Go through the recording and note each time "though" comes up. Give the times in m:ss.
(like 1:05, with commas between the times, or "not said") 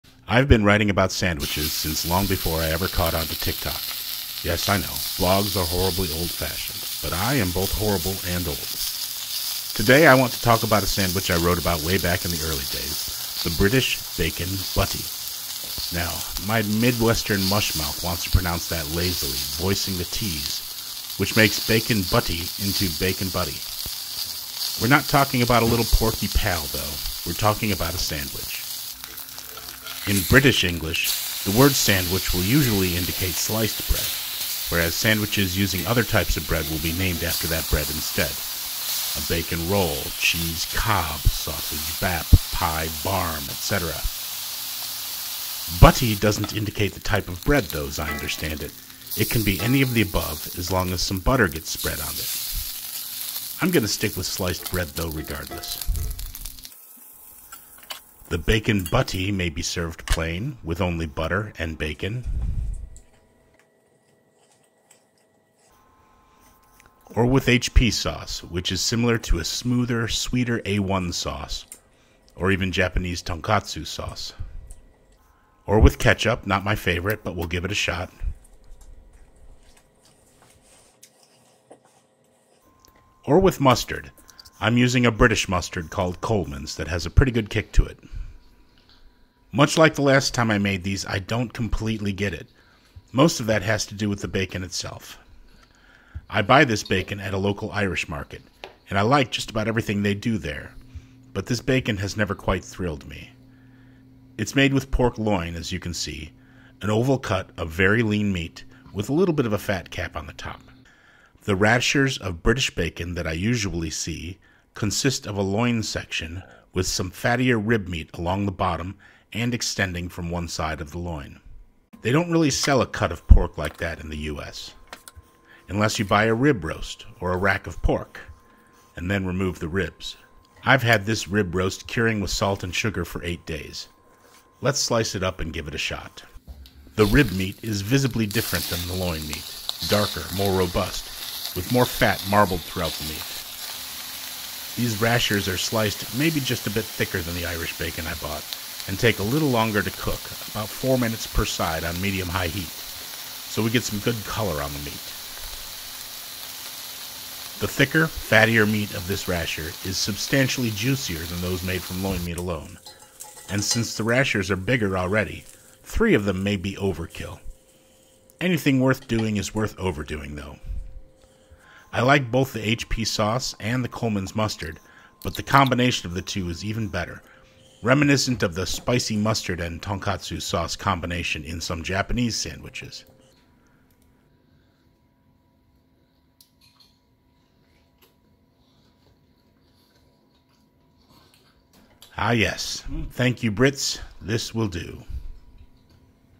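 0:26, 0:47, 0:54, 2:50.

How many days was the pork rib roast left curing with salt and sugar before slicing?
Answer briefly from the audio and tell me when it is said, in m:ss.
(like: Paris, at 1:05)
8, at 2:13.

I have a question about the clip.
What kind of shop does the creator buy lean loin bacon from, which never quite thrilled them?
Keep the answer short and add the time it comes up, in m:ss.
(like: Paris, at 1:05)
Irish market, at 1:37.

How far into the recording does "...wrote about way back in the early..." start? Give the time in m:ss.
0:11.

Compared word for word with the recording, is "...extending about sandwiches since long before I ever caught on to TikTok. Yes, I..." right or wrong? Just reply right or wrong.
wrong.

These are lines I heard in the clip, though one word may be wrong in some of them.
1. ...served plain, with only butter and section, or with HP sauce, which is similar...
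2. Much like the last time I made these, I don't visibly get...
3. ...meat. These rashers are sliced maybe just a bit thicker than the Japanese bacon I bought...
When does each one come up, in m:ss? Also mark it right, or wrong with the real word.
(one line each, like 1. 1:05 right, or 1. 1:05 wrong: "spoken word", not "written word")
1. 0:59 wrong: "bacon", not "section"
2. 1:29 wrong: "completely", not "visibly"
3. 2:23 wrong: "Irish", not "Japanese".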